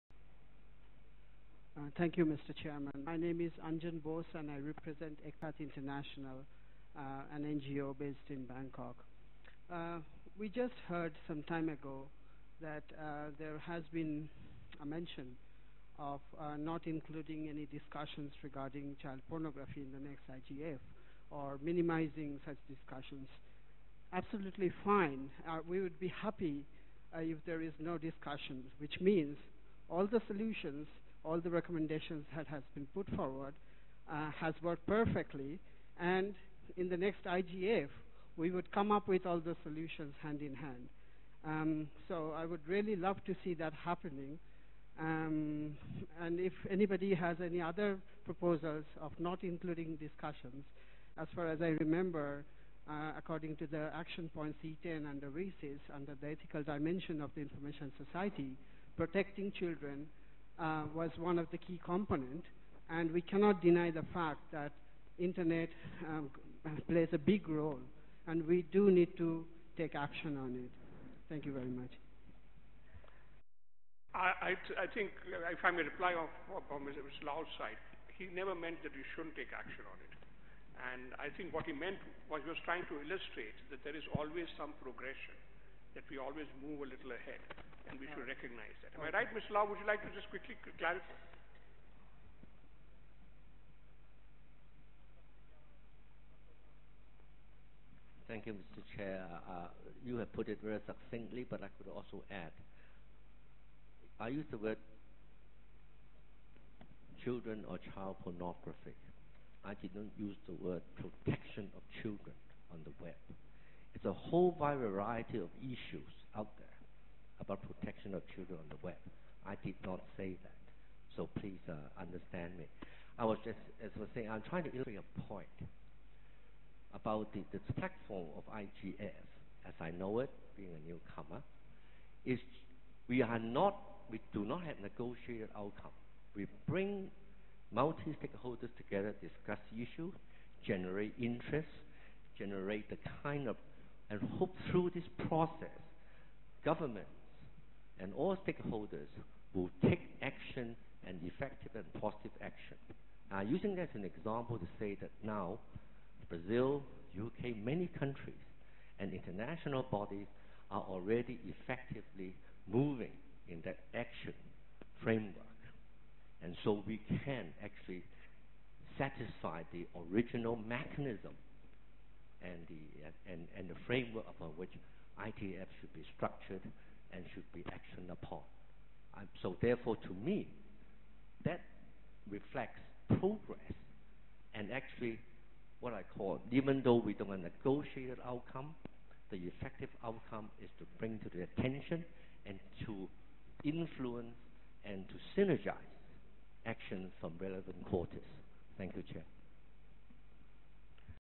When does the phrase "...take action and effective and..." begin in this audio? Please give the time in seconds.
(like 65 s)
149 s.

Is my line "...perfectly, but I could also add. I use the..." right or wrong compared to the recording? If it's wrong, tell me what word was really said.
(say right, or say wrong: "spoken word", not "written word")
wrong: "succinctly", not "perfectly".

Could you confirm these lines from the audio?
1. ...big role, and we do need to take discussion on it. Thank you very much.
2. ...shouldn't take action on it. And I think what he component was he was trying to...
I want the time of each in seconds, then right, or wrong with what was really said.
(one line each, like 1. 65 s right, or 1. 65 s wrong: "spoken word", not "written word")
1. 67 s wrong: "action", not "discussion"
2. 79 s wrong: "meant", not "component".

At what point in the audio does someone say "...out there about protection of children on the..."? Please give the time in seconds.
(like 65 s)
116 s.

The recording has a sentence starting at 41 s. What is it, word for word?
Um, so I would really love to see that happening.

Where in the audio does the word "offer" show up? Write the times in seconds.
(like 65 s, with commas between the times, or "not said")
not said.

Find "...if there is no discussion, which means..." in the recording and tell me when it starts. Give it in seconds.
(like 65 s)
27 s.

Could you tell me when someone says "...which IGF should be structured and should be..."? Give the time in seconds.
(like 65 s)
174 s.